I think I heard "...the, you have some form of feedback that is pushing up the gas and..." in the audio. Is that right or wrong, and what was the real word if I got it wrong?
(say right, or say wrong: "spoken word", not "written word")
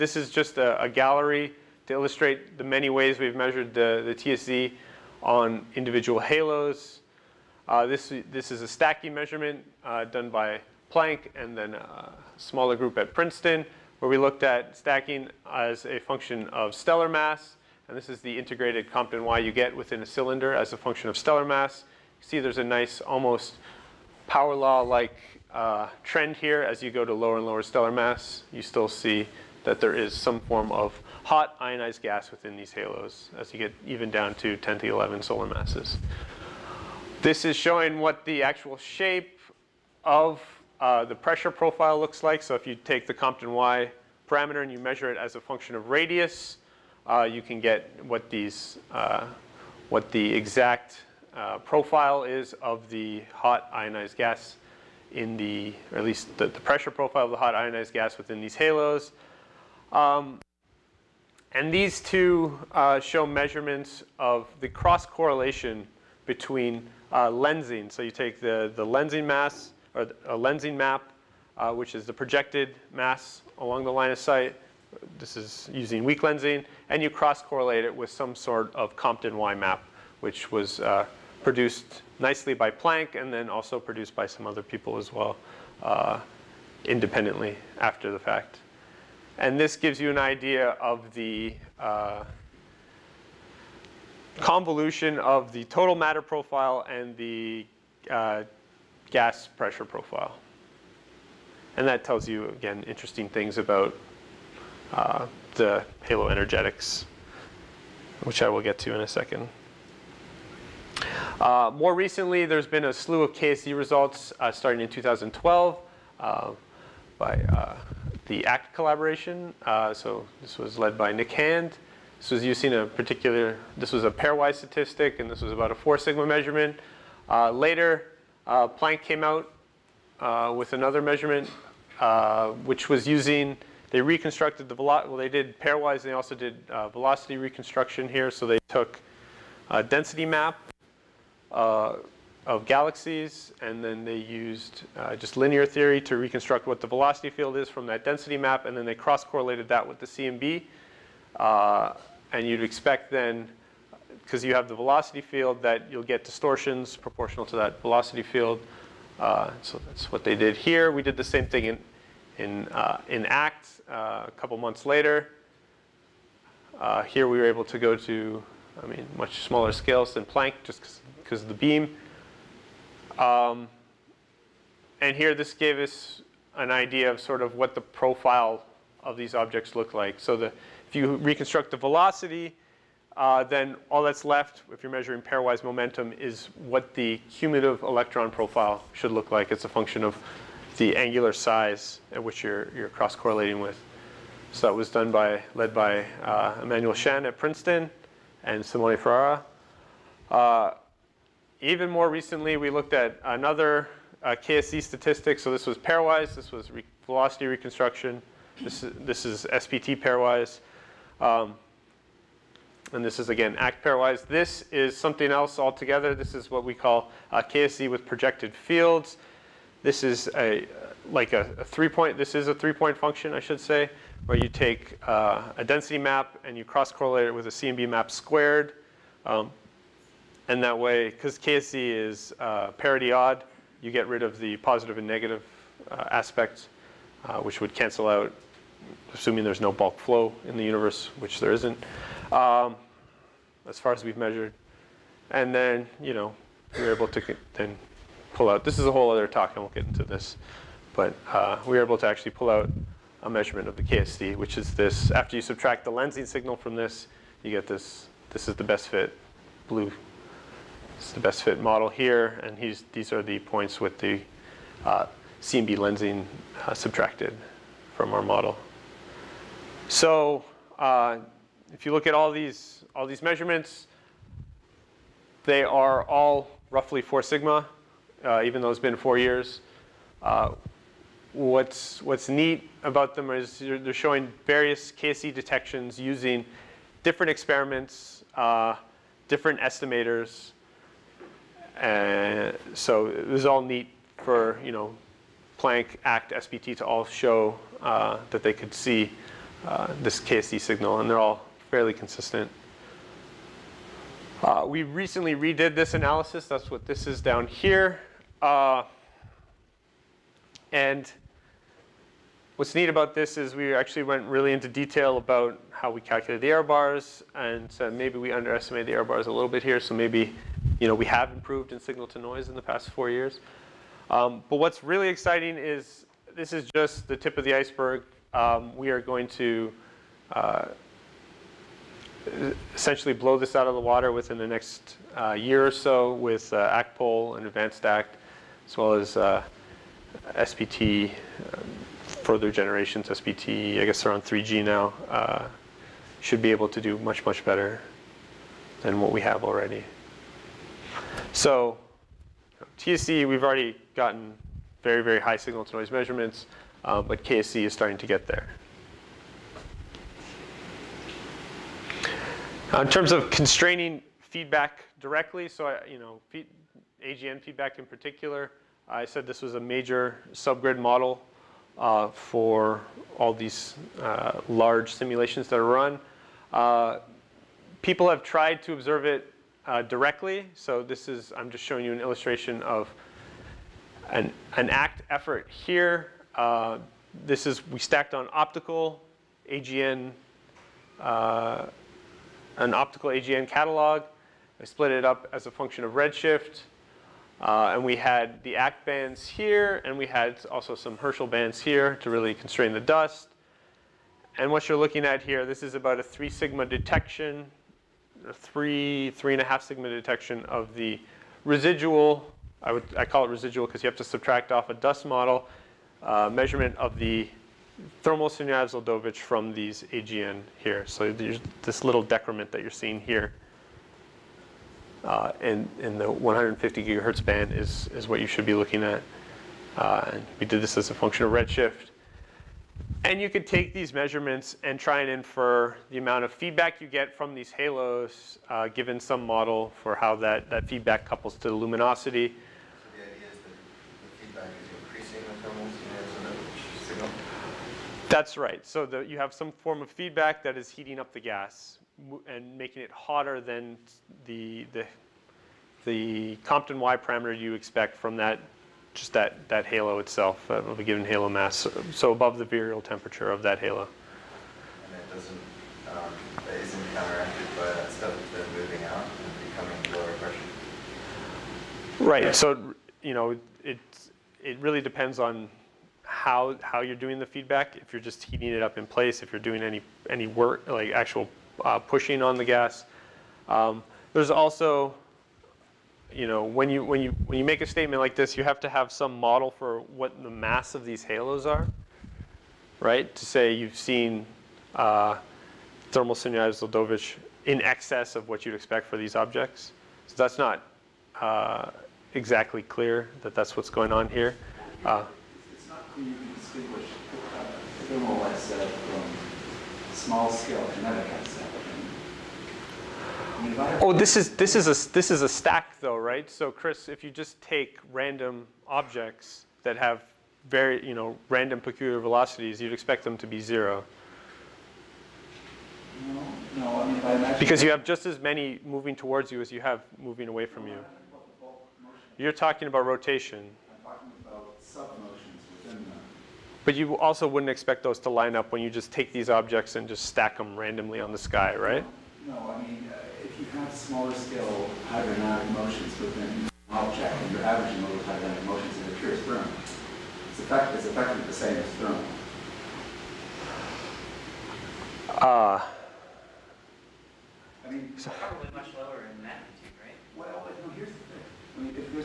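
wrong: "heating", not "pushing".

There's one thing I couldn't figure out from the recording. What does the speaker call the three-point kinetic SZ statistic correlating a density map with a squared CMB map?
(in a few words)
KSZ with projected fields.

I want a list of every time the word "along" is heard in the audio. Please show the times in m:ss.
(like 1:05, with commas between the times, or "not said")
1:13.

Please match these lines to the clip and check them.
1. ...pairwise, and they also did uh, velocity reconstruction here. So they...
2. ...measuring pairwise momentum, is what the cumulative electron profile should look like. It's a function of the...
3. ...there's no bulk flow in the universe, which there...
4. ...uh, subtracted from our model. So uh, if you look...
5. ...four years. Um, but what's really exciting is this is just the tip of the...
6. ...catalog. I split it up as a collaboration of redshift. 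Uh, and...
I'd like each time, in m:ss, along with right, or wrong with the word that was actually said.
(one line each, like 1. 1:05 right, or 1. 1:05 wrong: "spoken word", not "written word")
1. 2:15 right
2. 3:04 right
3. 3:59 right
4. 4:26 right
5. 5:22 right
6. 6:33 wrong: "function", not "collaboration".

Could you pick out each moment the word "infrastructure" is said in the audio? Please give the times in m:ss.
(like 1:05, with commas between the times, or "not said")
not said.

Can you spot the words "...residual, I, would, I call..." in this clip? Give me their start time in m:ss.
6:51.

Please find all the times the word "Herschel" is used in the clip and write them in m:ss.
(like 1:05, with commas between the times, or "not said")
6:40.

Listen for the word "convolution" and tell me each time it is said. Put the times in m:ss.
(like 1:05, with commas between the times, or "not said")
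1:34.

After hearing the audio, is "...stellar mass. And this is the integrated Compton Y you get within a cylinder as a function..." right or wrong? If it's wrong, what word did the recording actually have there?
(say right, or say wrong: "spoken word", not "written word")
right.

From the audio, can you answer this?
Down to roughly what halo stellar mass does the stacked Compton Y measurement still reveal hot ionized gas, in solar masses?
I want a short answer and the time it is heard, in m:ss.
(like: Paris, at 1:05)
10 to 11, at 0:34.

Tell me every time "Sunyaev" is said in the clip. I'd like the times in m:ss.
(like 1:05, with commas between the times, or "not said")
6:58, 8:16.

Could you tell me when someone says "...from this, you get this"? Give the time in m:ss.
4:16.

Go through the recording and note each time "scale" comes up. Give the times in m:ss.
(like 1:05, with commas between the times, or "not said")
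2:49, 8:30, 9:04.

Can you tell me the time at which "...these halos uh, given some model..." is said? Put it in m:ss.
7:17.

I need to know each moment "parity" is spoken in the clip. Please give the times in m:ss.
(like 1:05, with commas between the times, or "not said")
3:52.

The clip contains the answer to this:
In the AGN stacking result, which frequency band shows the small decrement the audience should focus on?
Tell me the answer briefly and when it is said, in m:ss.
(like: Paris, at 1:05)
150 gigahertz, at 7:06.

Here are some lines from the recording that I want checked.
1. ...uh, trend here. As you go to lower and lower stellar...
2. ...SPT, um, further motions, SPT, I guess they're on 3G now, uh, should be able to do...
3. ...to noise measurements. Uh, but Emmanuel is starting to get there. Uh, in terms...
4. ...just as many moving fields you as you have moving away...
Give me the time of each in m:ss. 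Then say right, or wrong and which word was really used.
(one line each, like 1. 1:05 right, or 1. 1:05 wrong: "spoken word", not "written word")
1. 0:25 right
2. 5:40 wrong: "generations", not "motions"
3. 5:55 wrong: "KSZ", not "Emmanuel"
4. 8:47 wrong: "towards", not "fields".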